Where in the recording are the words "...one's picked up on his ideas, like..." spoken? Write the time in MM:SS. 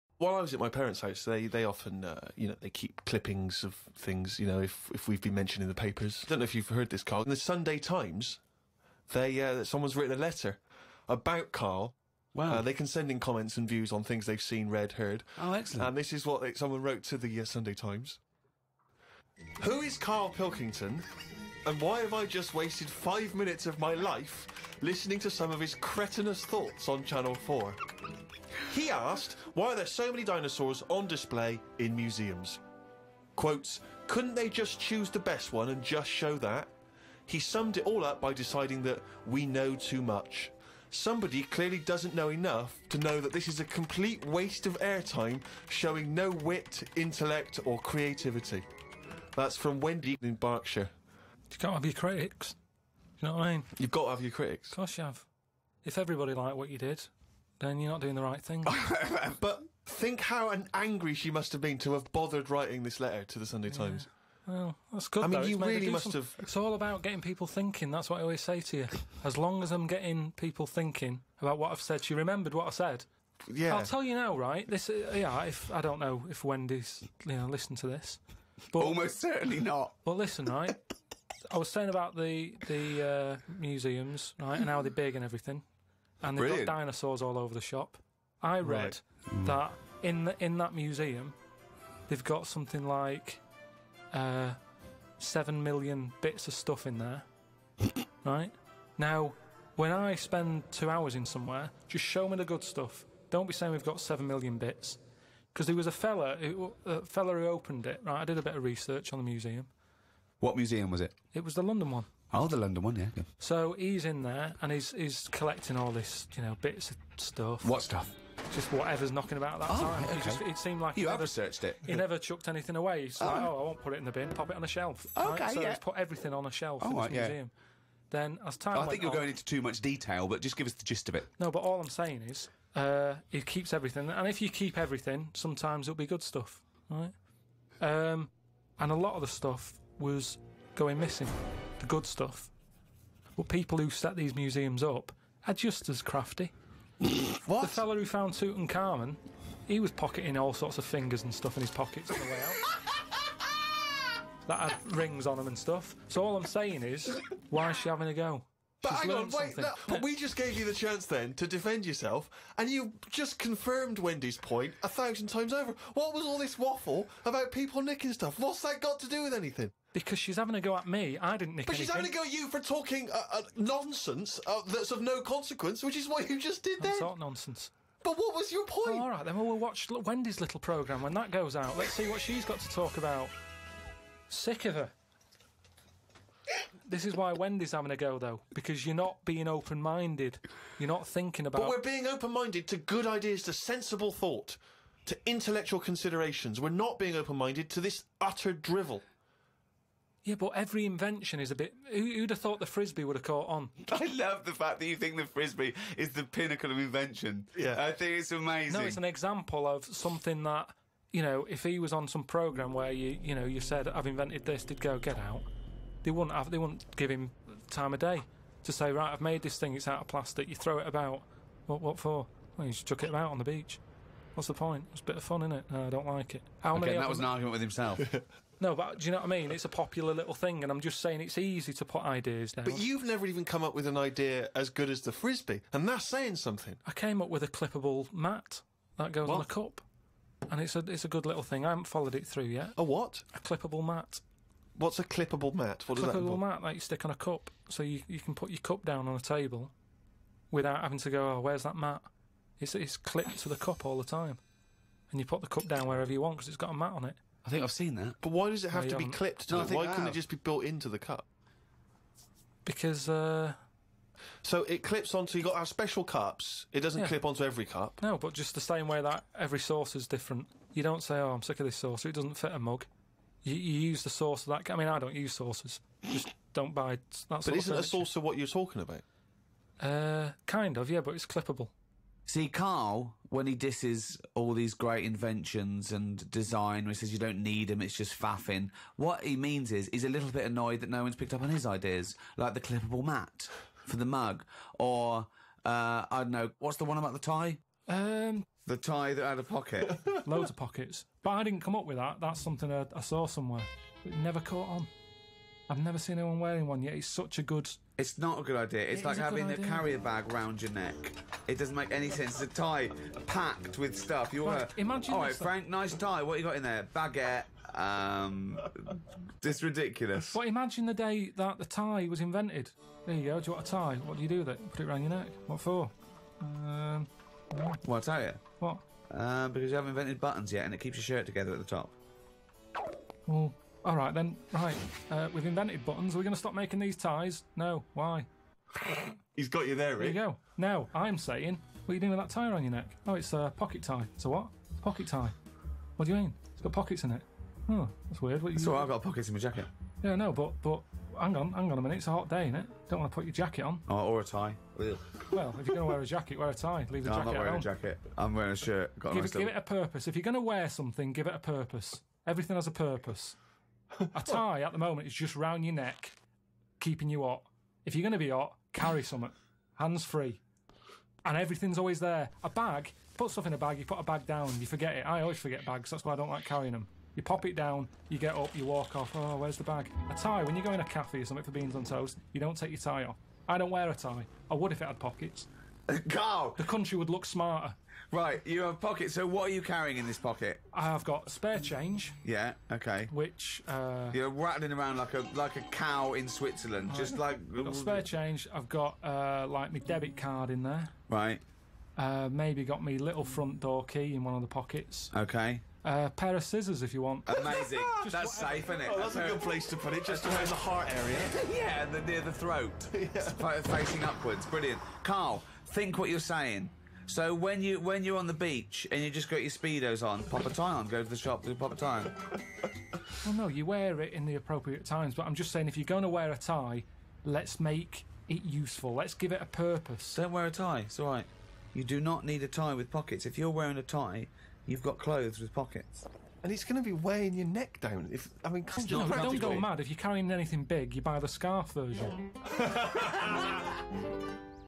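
04:51.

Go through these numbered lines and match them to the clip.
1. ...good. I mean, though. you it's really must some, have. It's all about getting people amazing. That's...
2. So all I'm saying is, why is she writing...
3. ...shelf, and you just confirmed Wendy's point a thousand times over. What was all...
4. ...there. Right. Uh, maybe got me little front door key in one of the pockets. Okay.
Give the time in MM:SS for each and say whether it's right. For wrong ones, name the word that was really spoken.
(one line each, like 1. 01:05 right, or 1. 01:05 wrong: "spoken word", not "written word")
1. 01:05 wrong: "thinking", not "amazing"
2. 02:36 wrong: "having", not "writing"
3. 02:41 wrong: "yourself", not "shelf"
4. 06:40 right.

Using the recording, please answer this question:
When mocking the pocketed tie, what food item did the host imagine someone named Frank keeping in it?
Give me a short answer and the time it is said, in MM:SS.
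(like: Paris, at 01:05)
baguette, at 05:16.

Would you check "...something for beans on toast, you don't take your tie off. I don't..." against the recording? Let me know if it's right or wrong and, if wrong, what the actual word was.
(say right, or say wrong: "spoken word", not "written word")
right.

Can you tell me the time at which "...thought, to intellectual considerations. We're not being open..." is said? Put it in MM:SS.
03:14.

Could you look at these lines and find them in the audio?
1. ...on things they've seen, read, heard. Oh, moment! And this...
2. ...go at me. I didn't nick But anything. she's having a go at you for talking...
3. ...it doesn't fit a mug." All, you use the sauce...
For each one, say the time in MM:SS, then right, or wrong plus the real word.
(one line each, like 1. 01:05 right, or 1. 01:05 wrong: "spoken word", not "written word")
1. 00:13 wrong: "excellent", not "moment"
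2. 02:50 right
3. 04:32 wrong: "You", not "All".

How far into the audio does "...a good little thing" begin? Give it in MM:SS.
04:01.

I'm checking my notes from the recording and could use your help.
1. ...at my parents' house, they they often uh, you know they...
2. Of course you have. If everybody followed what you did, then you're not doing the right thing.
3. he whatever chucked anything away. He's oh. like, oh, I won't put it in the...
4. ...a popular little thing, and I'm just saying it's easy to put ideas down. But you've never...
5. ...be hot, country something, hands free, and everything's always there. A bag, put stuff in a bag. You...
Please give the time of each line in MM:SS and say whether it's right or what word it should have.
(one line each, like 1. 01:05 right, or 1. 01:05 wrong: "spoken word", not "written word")
1. 00:00 right
2. 00:54 wrong: "liked", not "followed"
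3. 02:01 wrong: "never", not "whatever"
4. 03:49 right
5. 06:08 wrong: "carry", not "country".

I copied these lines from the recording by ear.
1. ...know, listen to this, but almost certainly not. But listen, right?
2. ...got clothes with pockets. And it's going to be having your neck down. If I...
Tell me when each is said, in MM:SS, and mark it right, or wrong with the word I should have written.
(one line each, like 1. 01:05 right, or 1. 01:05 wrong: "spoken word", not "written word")
1. 01:17 right
2. 07:14 wrong: "weighing", not "having".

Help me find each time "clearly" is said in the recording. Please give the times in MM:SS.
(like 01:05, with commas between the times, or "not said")
00:41.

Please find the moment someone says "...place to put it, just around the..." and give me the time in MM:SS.
06:49.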